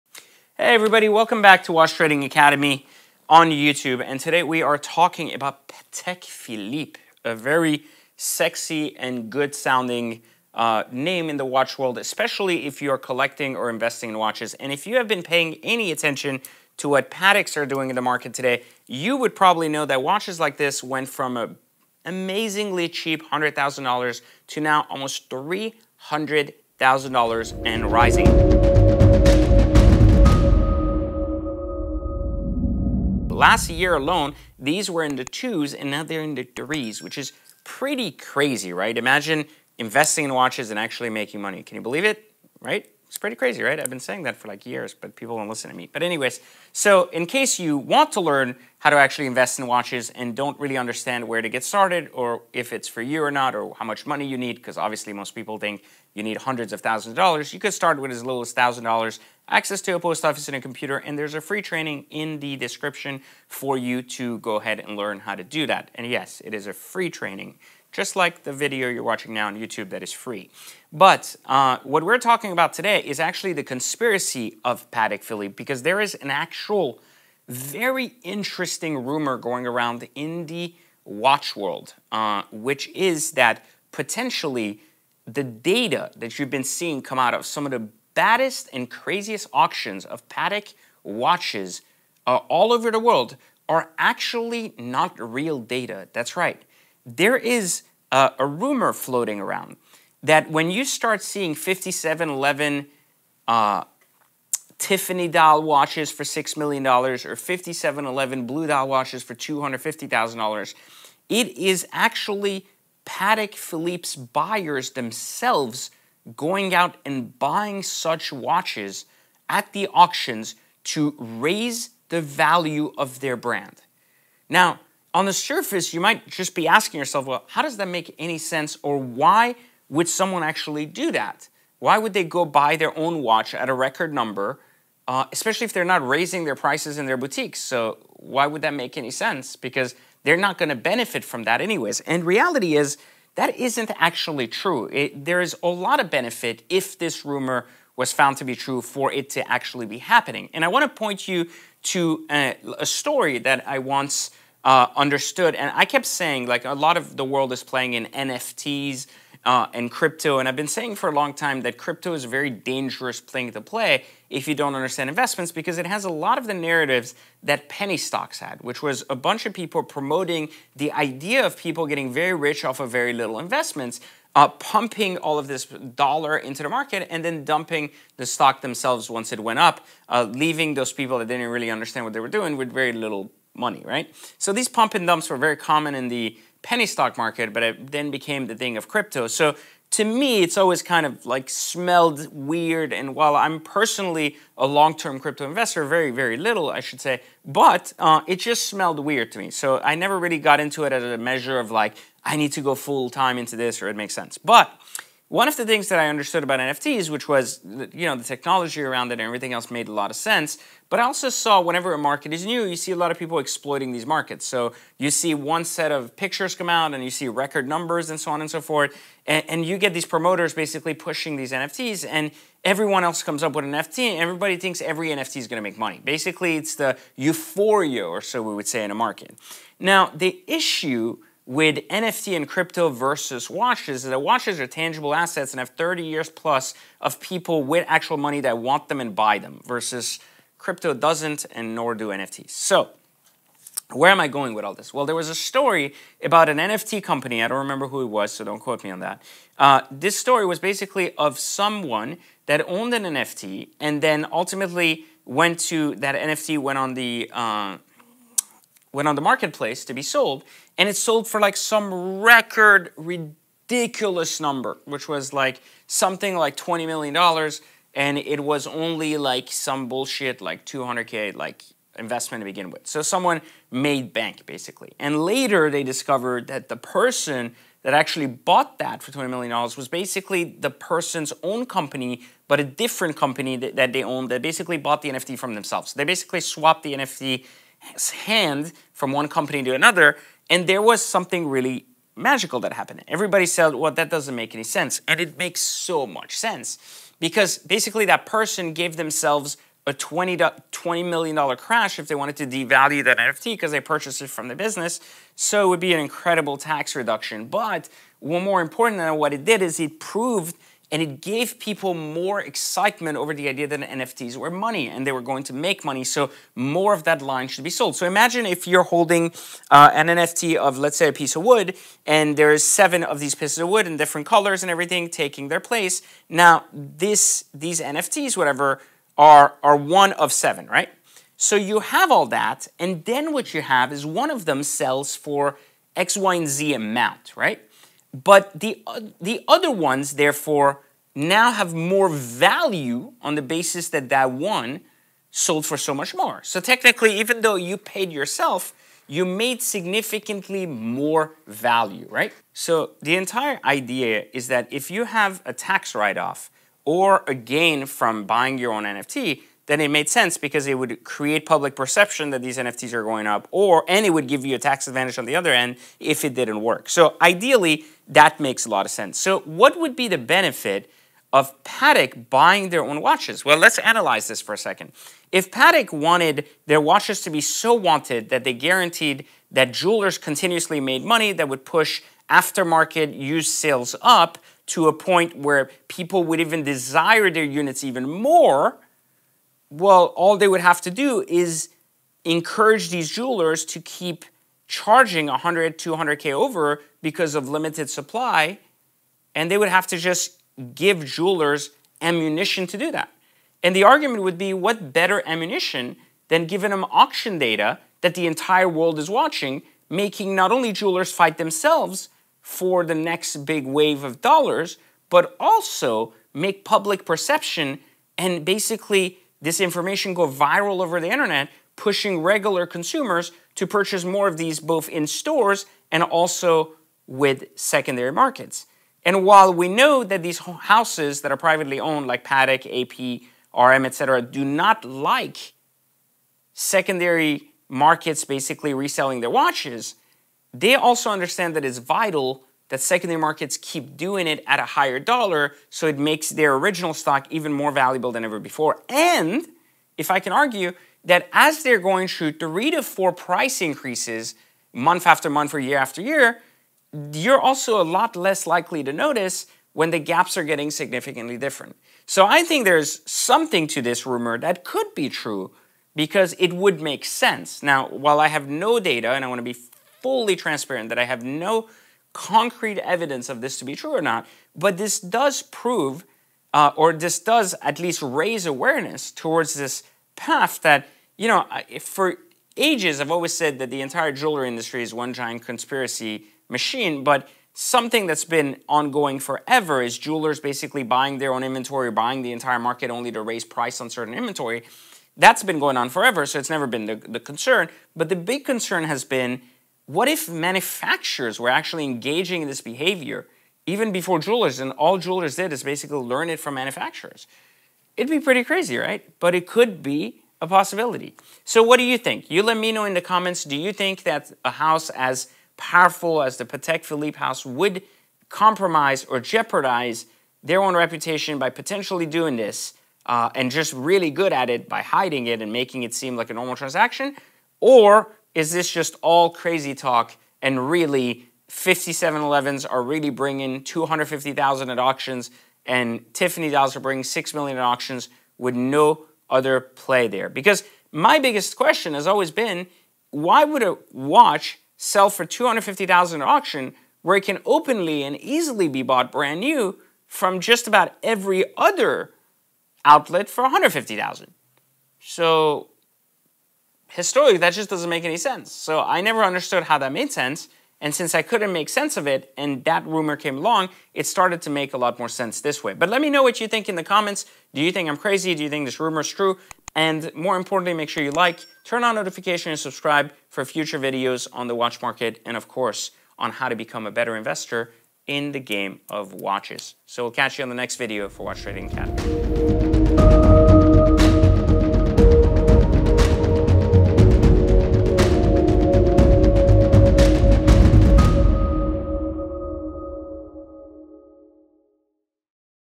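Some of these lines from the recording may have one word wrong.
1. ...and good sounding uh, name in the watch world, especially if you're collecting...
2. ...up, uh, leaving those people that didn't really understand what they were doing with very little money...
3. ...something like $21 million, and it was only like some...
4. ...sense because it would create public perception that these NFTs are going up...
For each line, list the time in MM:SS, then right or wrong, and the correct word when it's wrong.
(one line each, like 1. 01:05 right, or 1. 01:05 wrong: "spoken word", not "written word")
1. 00:08 right
2. 02:59 right
3. 04:25 wrong: "20", not "21"
4. 06:00 right.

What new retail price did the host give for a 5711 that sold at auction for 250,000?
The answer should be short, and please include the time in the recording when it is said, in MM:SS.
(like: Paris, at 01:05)
150,000, at 09:13.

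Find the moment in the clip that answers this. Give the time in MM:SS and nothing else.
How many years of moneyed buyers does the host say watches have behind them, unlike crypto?
03:55.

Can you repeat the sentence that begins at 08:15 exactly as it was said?
That's been going on forever, so it's never been the, the concern.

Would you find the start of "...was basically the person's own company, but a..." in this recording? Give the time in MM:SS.
04:39.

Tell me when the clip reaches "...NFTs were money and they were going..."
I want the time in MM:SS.
05:13.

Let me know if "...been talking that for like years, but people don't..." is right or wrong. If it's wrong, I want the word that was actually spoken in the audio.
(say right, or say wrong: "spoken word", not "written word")
wrong: "saying", not "talking".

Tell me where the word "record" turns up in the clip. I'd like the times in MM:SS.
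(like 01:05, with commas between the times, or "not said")
02:13, 03:37, 04:22.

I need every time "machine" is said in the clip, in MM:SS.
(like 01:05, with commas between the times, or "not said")
08:06.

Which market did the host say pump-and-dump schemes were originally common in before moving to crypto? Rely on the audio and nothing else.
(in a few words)
penny stock market.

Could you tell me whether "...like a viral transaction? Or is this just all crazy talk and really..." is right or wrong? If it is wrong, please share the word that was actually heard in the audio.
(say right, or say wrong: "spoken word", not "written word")
wrong: "normal", not "viral".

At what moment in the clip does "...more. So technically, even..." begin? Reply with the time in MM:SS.
05:46.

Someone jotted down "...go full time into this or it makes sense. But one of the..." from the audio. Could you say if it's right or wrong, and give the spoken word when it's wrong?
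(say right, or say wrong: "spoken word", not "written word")
right.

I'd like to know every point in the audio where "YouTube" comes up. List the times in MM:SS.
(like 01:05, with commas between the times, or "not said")
00:03, 01:09.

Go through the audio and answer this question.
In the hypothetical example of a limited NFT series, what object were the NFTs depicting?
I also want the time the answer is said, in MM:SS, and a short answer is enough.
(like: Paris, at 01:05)
a piece of wood, at 05:21.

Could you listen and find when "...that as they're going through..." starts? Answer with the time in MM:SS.
07:31.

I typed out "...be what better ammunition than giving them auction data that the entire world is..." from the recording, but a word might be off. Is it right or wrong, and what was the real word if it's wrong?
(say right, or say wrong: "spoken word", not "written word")
right.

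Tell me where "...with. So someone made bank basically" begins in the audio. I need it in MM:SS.
04:32.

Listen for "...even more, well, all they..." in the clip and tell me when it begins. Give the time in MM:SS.
06:27.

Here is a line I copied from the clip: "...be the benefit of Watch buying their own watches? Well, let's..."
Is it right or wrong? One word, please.
wrong.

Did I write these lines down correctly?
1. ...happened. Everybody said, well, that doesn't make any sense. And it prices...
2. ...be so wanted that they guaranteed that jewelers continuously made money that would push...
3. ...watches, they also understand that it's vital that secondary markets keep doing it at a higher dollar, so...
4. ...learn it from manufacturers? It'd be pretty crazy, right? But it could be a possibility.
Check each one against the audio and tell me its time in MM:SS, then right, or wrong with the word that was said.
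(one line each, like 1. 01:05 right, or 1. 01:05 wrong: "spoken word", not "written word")
1. 04:52 wrong: "makes", not "prices"
2. 06:17 right
3. 07:19 right
4. 08:25 right.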